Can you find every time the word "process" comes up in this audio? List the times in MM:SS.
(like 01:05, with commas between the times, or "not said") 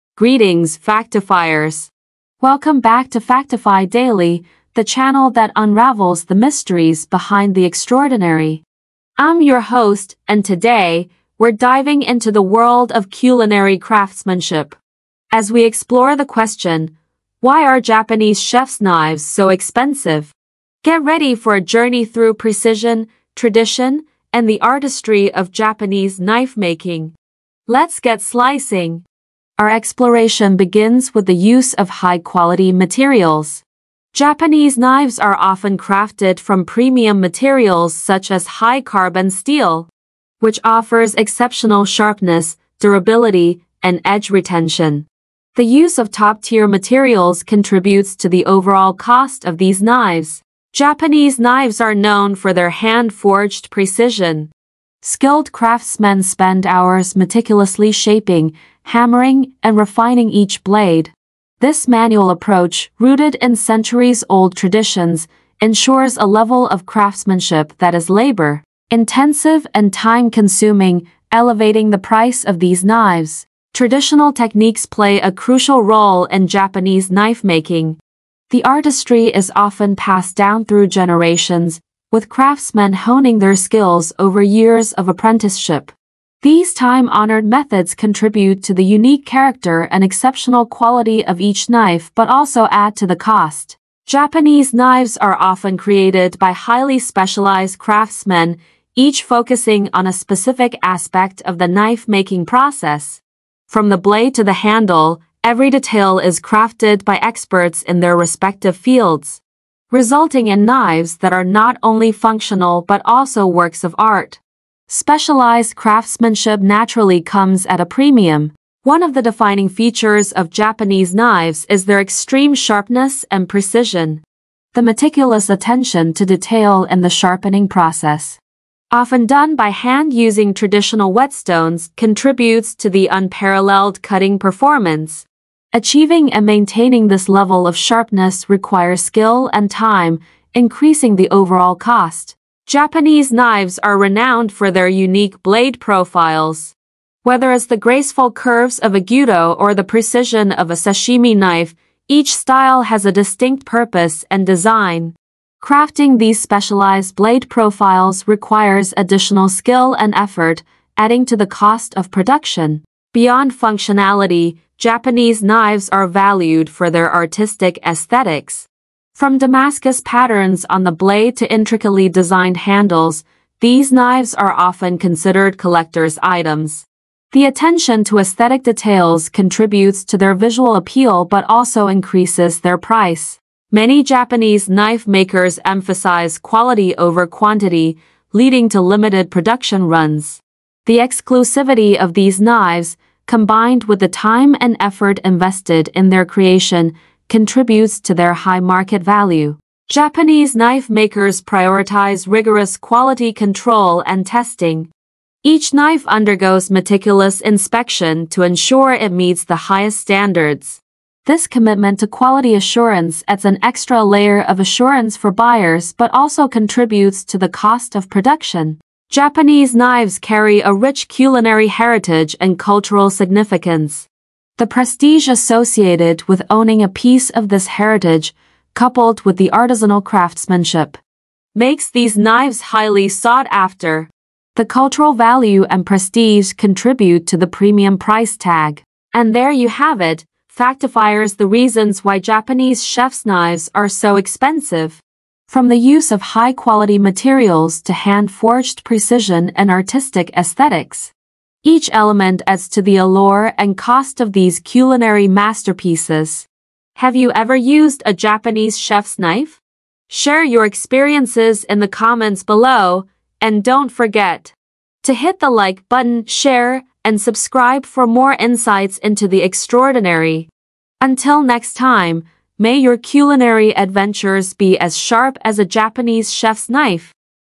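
01:42, 02:07.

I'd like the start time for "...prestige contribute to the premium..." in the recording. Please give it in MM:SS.
03:55.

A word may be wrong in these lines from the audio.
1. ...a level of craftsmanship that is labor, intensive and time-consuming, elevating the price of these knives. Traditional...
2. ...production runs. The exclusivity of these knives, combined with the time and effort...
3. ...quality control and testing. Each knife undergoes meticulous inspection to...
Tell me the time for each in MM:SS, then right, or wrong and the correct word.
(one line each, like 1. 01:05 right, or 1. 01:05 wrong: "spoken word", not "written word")
1. 01:06 right
2. 03:09 right
3. 03:22 right.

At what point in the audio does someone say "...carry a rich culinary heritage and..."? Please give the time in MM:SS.
03:40.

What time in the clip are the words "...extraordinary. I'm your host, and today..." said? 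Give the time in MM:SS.
00:07.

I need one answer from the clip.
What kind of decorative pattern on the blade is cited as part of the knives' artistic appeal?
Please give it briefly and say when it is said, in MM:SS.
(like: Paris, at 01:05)
Damascus patterns, at 02:49.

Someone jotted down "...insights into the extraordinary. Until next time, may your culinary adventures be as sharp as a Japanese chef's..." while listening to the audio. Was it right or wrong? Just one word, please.
right.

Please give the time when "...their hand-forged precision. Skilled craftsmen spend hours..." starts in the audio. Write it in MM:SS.
00:52.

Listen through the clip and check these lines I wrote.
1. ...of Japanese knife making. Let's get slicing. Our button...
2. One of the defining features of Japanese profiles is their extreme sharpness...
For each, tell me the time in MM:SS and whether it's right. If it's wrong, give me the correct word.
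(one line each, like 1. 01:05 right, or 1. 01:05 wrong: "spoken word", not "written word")
1. 00:25 wrong: "exploration", not "button"
2. 01:58 wrong: "knives", not "profiles".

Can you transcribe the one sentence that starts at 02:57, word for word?
The attention to aesthetic details contributes to their visual appeal but also increases their price.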